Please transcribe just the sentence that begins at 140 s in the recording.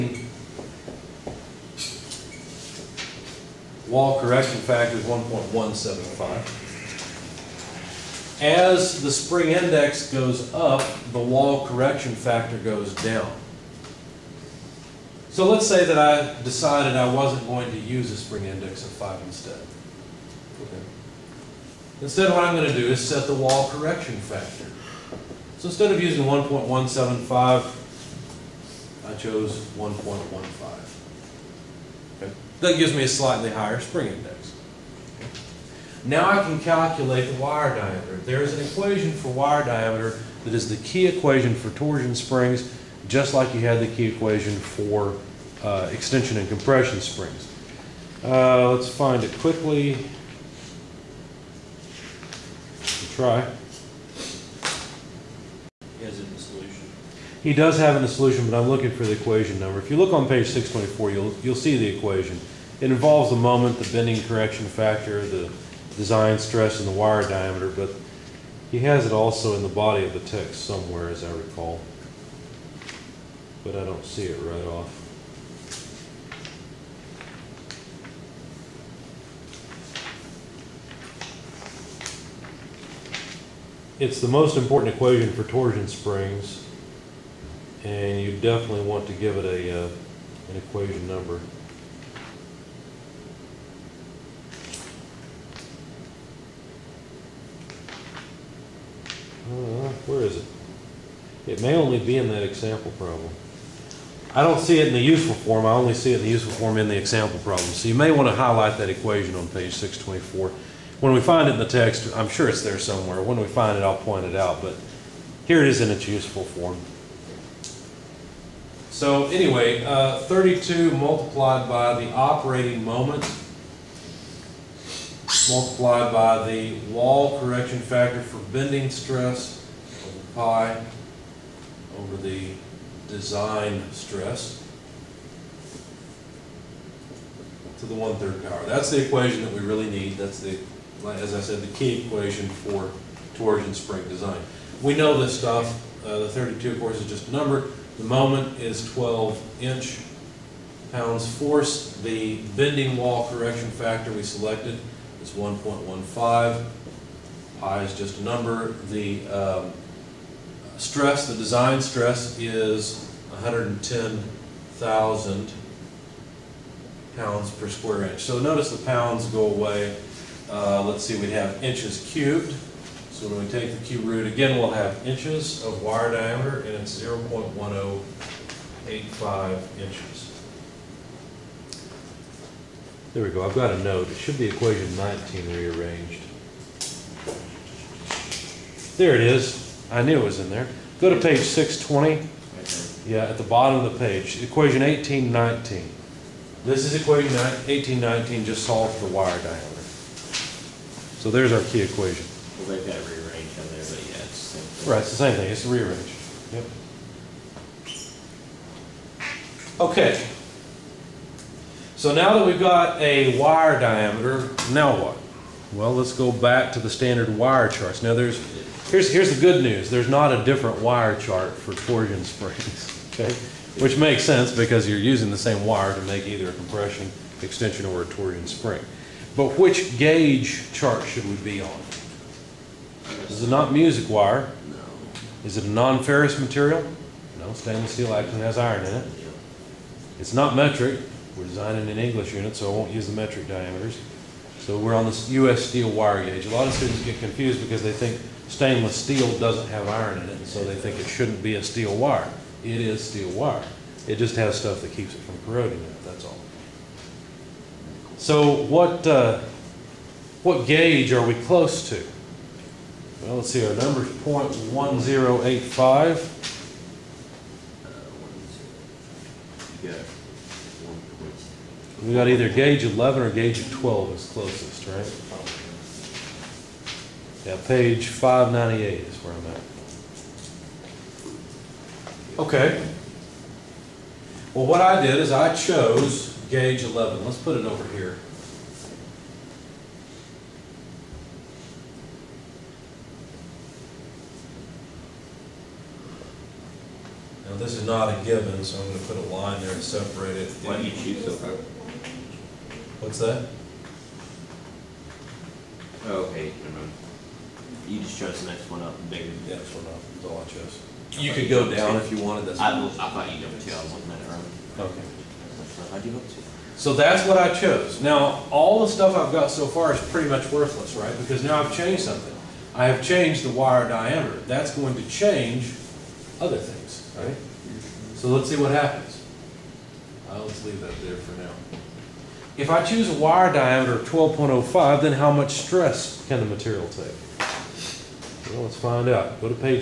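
That's the, as I said, the key equation for torsion spring design.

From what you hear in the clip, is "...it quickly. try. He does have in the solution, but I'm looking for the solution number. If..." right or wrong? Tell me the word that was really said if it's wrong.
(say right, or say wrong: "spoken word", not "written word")
wrong: "equation", not "solution".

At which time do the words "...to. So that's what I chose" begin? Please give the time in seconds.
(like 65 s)
316 s.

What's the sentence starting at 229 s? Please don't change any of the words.
But which gauge chart should we be on?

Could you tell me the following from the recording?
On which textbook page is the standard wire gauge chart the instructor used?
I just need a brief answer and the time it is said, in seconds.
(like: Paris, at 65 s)
598, at 278 s.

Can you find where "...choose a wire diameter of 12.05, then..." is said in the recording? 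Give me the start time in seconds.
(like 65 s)
332 s.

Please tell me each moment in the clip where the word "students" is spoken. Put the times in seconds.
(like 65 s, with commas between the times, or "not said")
246 s.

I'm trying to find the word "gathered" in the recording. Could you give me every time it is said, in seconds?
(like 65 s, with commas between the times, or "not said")
not said.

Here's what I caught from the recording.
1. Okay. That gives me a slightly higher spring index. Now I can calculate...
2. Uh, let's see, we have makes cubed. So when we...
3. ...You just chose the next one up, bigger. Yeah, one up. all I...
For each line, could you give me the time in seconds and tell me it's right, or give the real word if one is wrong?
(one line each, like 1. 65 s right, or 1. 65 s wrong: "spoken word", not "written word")
1. 32 s right
2. 170 s wrong: "inches", not "makes"
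3. 307 s right.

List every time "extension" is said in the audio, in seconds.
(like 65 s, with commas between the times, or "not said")
45 s, 227 s.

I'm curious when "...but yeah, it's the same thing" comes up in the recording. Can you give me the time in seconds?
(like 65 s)
203 s.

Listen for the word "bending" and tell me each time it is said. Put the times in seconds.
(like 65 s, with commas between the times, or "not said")
63 s, 128 s, 152 s.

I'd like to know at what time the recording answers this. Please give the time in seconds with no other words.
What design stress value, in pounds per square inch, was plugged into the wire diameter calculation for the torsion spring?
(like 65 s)
163 s.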